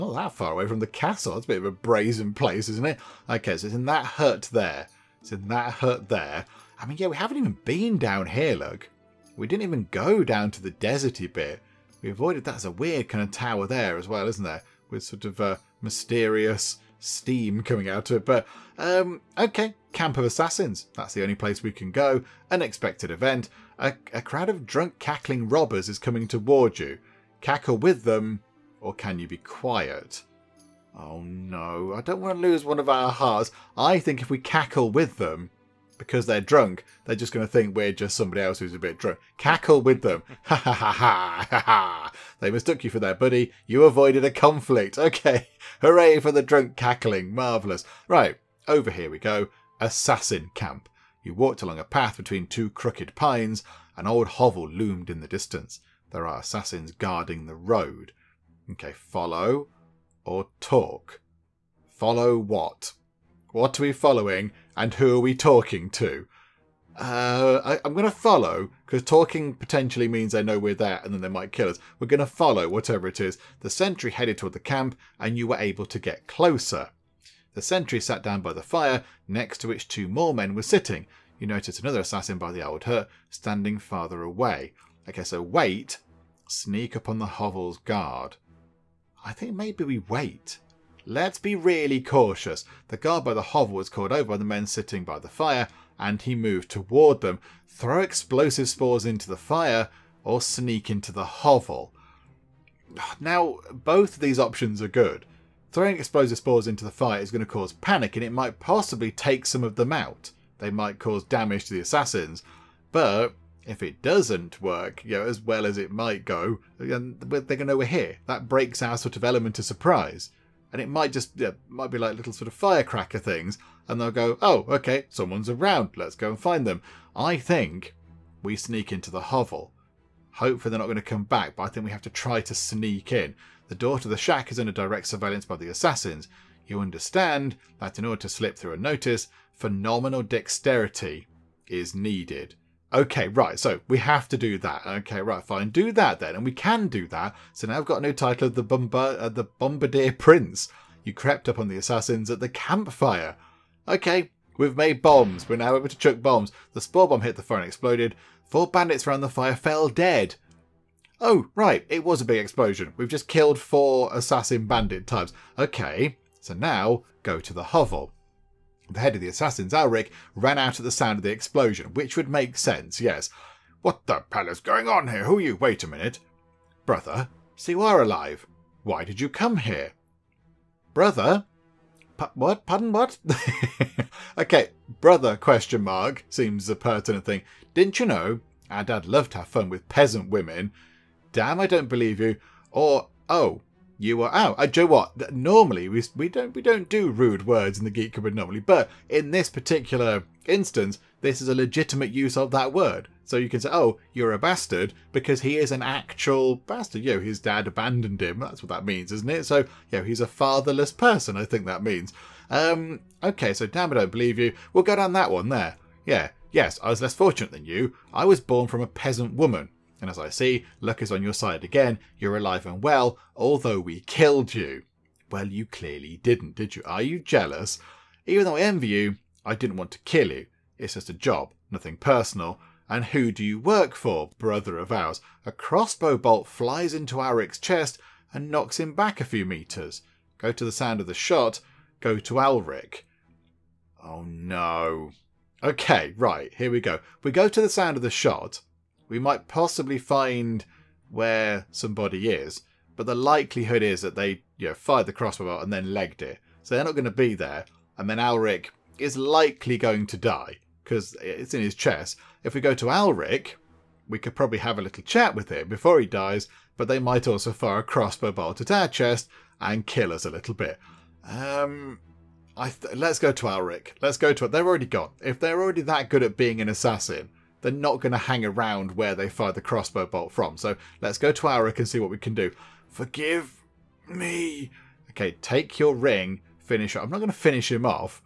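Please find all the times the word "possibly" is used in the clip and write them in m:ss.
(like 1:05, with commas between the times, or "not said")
1:48, 4:09.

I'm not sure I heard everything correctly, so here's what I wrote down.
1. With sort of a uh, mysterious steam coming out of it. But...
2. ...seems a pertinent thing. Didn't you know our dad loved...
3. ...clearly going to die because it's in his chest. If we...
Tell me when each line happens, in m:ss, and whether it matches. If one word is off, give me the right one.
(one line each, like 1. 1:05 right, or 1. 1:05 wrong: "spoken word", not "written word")
1. 0:14 right
2. 3:06 right
3. 4:19 wrong: "likely", not "clearly".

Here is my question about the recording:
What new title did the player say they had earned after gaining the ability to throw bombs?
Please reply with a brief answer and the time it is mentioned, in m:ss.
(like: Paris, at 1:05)
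The Bombardier Prince, at 2:29.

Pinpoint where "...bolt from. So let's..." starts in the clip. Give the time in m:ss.
4:40.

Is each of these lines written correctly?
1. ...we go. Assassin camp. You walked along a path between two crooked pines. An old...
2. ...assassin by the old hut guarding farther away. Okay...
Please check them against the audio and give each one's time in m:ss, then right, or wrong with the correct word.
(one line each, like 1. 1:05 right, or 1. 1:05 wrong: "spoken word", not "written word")
1. 0:49 right
2. 1:21 wrong: "standing", not "guarding".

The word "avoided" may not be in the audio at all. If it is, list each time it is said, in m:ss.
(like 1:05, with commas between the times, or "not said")
0:12, 0:43.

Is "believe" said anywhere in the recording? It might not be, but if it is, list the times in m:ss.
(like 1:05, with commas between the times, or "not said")
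3:11, 3:34.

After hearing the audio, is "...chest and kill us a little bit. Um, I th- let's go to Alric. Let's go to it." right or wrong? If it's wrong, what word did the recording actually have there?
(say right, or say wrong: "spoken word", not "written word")
right.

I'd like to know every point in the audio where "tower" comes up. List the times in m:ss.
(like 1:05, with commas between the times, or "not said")
0:13.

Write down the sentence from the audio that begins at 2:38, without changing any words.
Four bandits around the fire fell dead.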